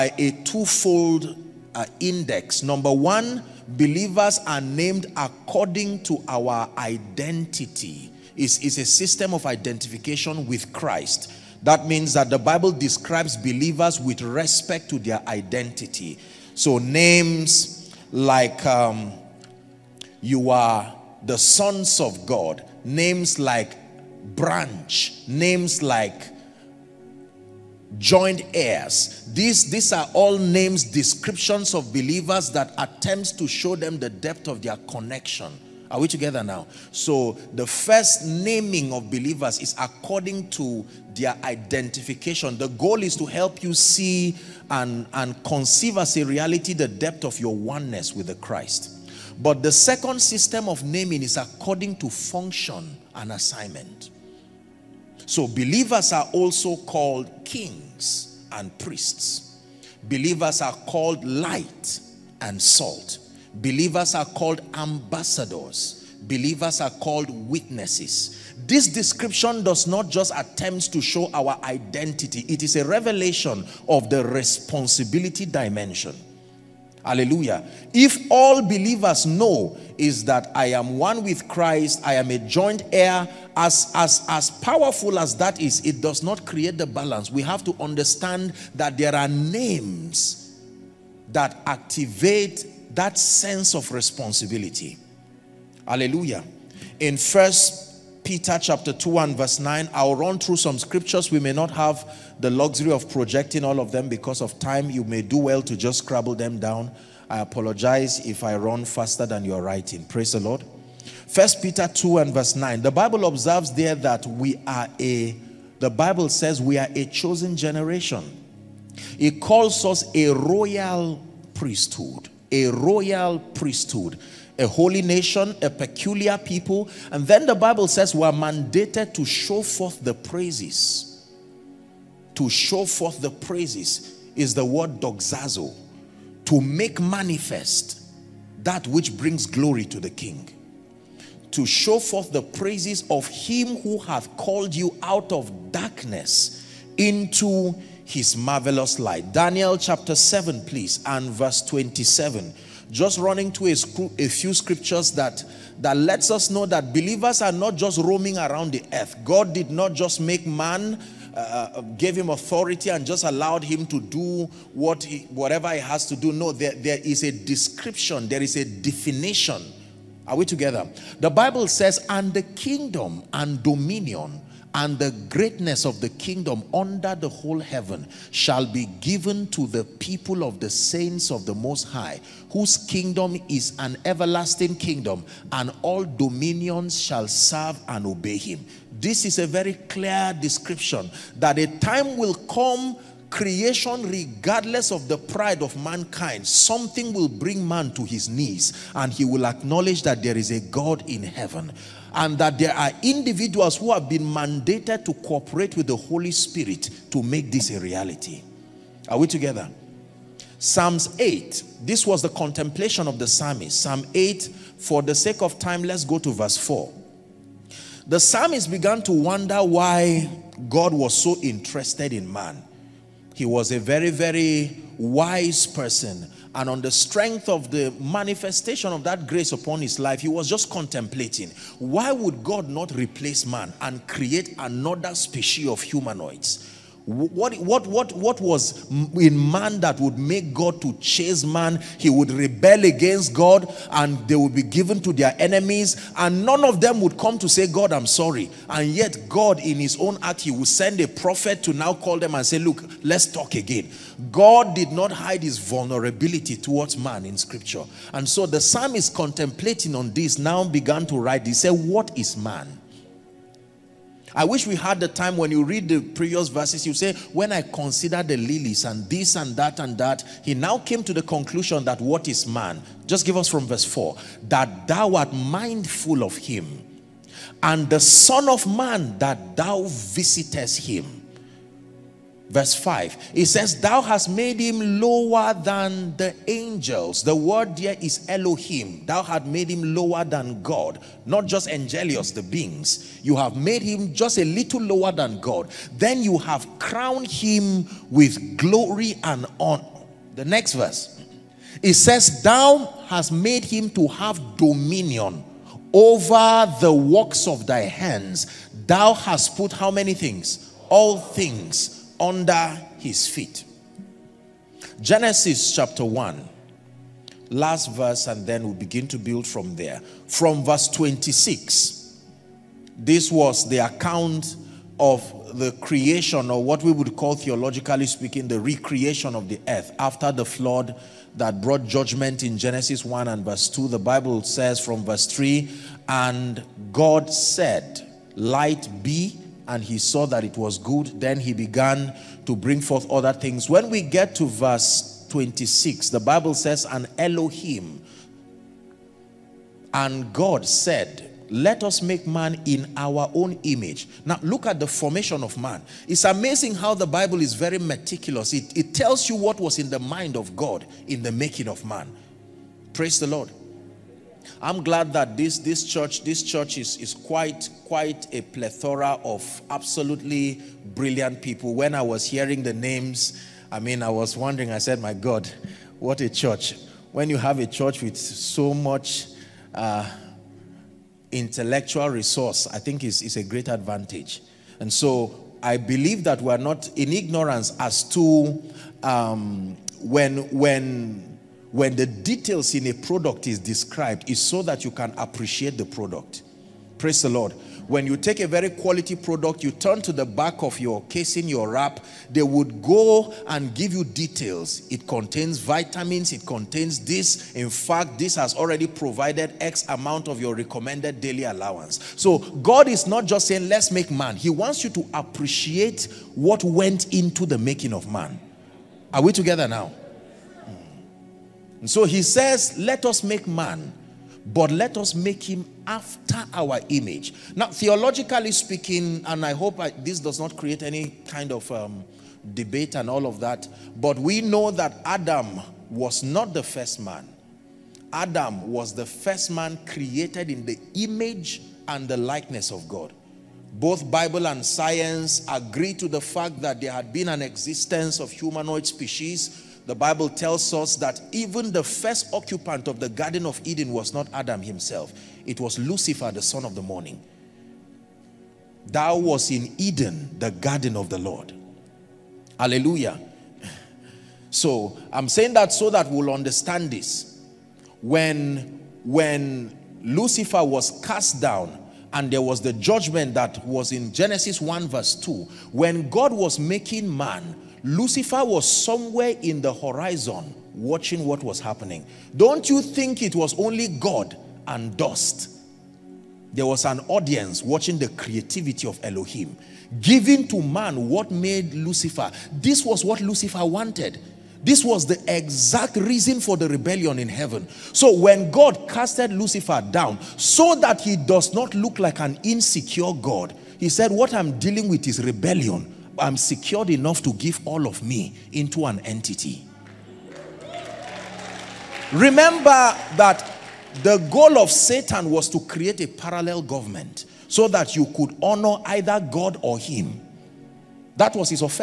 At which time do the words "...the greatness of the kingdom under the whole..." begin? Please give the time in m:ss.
2:54.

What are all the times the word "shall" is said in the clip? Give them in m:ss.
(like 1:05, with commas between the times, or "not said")
2:58, 3:06.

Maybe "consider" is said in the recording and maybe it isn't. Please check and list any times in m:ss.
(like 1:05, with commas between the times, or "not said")
4:27.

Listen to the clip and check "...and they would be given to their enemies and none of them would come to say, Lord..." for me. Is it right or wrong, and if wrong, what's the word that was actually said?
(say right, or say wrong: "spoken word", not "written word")
wrong: "God", not "Lord".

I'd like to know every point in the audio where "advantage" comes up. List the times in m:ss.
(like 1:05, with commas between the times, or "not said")
6:23.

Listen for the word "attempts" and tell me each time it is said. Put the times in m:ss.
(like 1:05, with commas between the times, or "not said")
0:32, 1:10.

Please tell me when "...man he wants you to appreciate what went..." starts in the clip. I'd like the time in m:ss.
6:54.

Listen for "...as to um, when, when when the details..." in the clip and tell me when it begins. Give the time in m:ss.
6:27.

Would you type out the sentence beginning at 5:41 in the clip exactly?
Then he began to bring forth other things.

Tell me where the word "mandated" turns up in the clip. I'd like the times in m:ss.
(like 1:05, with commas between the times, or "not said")
2:08, 3:24.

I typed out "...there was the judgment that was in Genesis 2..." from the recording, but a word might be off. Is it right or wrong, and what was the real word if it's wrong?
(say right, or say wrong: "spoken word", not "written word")
wrong: "1", not "2".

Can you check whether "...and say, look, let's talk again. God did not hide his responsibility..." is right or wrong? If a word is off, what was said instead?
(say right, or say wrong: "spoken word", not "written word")
wrong: "vulnerability", not "responsibility".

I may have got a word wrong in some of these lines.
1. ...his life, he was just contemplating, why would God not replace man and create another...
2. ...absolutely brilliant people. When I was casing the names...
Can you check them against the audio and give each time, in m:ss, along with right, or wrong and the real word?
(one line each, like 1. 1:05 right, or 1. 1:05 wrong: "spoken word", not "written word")
1. 3:49 right
2. 6:09 wrong: "hearing", not "casing".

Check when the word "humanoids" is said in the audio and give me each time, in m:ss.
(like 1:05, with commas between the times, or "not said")
3:55, 7:28.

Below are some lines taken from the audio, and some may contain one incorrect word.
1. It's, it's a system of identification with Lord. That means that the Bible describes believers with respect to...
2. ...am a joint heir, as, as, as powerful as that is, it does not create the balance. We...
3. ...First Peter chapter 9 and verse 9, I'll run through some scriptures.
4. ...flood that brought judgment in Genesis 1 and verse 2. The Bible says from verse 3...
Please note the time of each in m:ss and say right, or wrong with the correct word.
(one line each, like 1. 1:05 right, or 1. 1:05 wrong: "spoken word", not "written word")
1. 0:08 wrong: "Christ", not "Lord"
2. 1:22 right
3. 1:37 wrong: "2", not "9"
4. 5:30 right.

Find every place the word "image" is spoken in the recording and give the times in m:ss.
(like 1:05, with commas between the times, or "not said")
5:53, 7:06, 7:20.